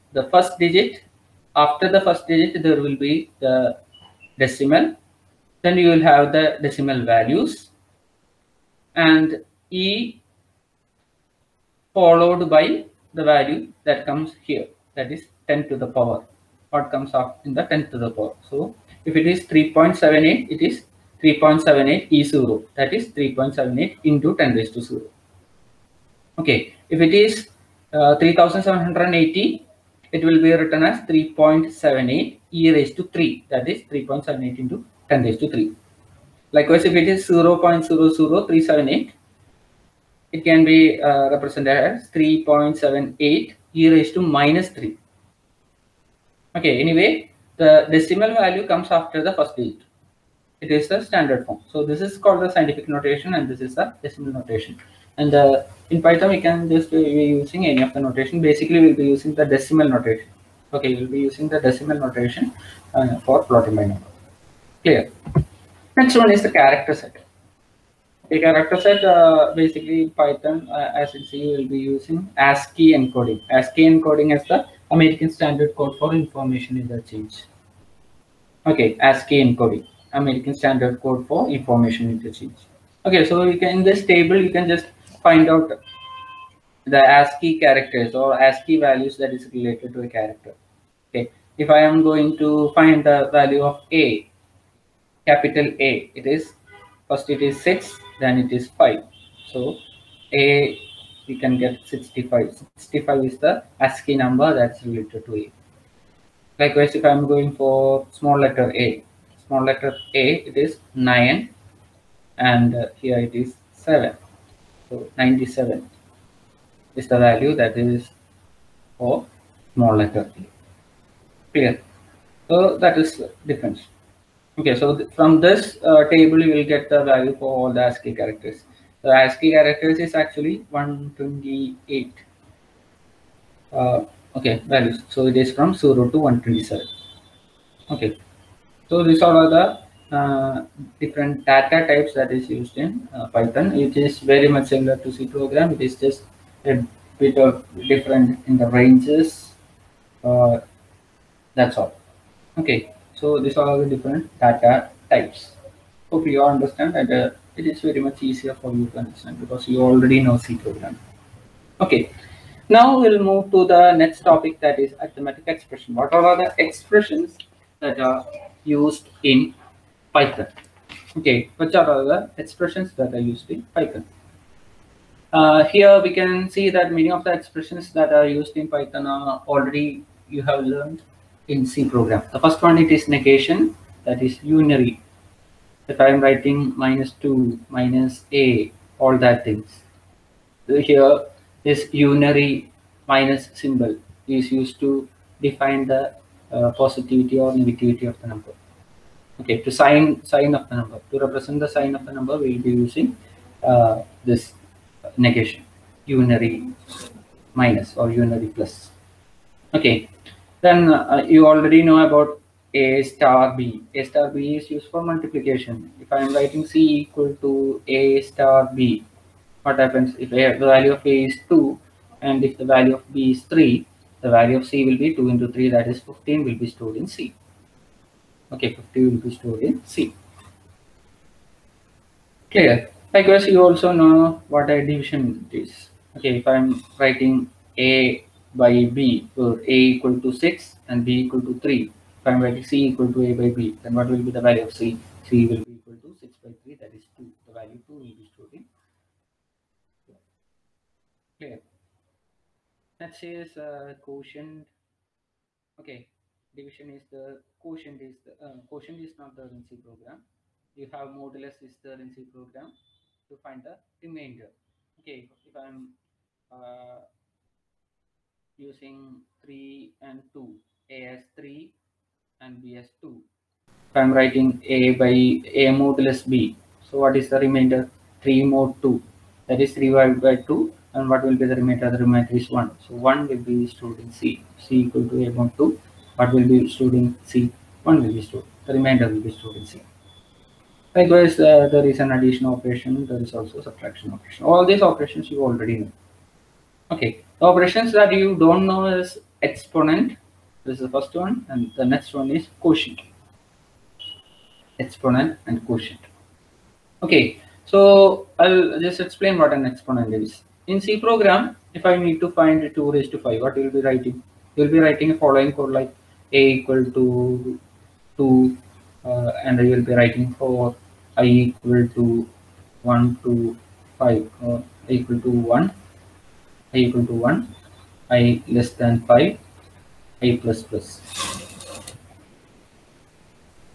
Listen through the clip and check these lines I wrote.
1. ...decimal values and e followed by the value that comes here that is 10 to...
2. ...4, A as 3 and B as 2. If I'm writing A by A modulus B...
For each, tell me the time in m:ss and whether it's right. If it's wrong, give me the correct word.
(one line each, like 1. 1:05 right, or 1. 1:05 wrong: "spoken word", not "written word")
1. 0:06 right
2. 4:30 wrong: "2", not "4".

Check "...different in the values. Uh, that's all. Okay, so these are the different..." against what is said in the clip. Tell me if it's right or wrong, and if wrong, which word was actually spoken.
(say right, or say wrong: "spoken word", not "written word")
wrong: "ranges", not "values".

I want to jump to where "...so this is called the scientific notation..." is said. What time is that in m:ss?
0:51.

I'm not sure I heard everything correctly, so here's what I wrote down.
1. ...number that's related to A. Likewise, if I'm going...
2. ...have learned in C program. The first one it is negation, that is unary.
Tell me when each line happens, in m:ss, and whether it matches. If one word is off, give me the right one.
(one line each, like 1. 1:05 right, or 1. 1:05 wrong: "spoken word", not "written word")
1. 1:44 right
2. 3:00 right.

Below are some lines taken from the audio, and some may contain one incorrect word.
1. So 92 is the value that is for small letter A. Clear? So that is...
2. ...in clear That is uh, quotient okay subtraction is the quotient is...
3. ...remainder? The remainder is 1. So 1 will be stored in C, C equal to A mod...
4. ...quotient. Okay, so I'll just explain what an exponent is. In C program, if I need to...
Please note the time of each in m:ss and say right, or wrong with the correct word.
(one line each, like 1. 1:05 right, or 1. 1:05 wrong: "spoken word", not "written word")
1. 1:54 wrong: "97", not "92"
2. 4:08 wrong: "division", not "subtraction"
3. 4:41 right
4. 5:05 right.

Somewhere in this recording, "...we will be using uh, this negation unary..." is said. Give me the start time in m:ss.
3:22.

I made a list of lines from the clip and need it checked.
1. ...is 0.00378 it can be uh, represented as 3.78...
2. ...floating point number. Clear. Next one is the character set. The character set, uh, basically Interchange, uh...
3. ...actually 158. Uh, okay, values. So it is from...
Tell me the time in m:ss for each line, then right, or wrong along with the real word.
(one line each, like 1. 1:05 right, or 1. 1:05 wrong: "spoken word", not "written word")
1. 0:37 right
2. 1:03 wrong: "Python", not "Interchange"
3. 2:10 wrong: "128", not "158".